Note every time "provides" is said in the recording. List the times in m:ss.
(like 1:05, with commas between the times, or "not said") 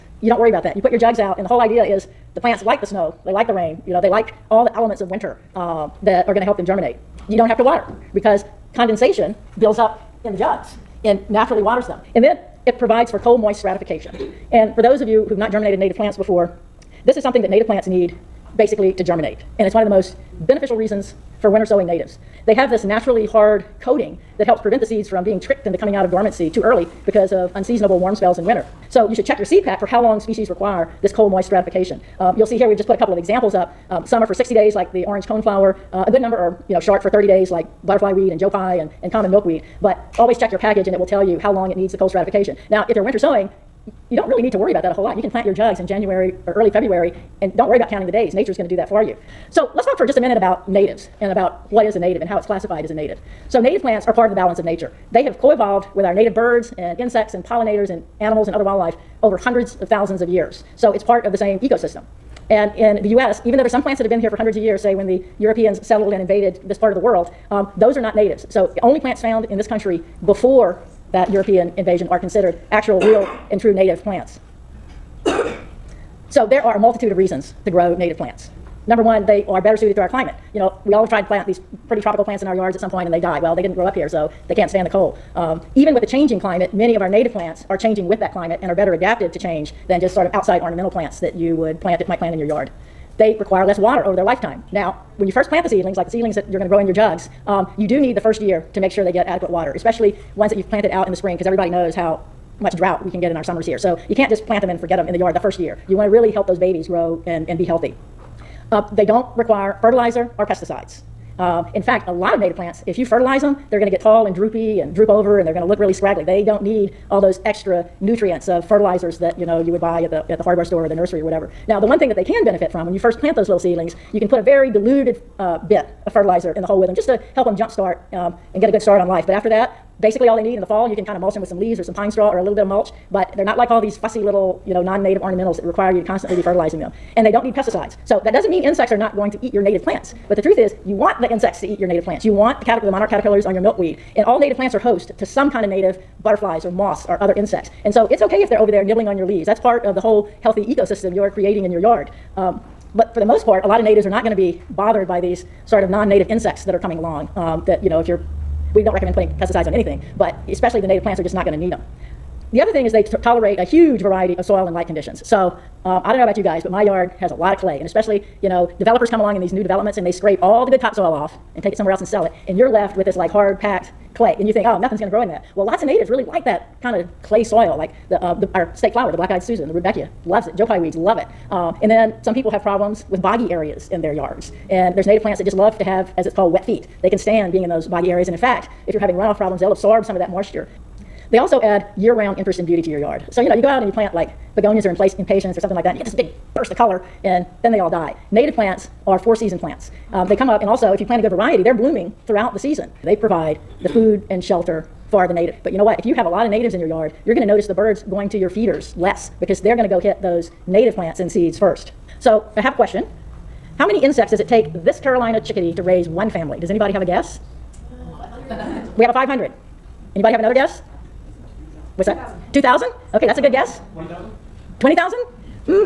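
0:12, 3:23.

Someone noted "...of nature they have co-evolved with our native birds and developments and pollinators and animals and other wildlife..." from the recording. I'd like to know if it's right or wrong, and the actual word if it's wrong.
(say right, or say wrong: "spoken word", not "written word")
wrong: "insects", not "developments".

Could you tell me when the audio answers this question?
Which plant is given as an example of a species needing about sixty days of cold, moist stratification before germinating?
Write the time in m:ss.
0:35.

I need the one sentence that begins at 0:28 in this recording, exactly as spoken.
So you should check your seed pack for how long species require this cold moist stratification.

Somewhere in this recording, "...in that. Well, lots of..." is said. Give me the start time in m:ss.
2:55.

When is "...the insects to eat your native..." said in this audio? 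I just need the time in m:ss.
2:21.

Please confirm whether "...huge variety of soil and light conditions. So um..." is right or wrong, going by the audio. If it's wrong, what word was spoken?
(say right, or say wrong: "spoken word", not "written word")
right.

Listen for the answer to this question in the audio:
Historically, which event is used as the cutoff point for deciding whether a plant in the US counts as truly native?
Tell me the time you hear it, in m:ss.
1:11.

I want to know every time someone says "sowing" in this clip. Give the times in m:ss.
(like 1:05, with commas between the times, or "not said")
0:21, 0:43.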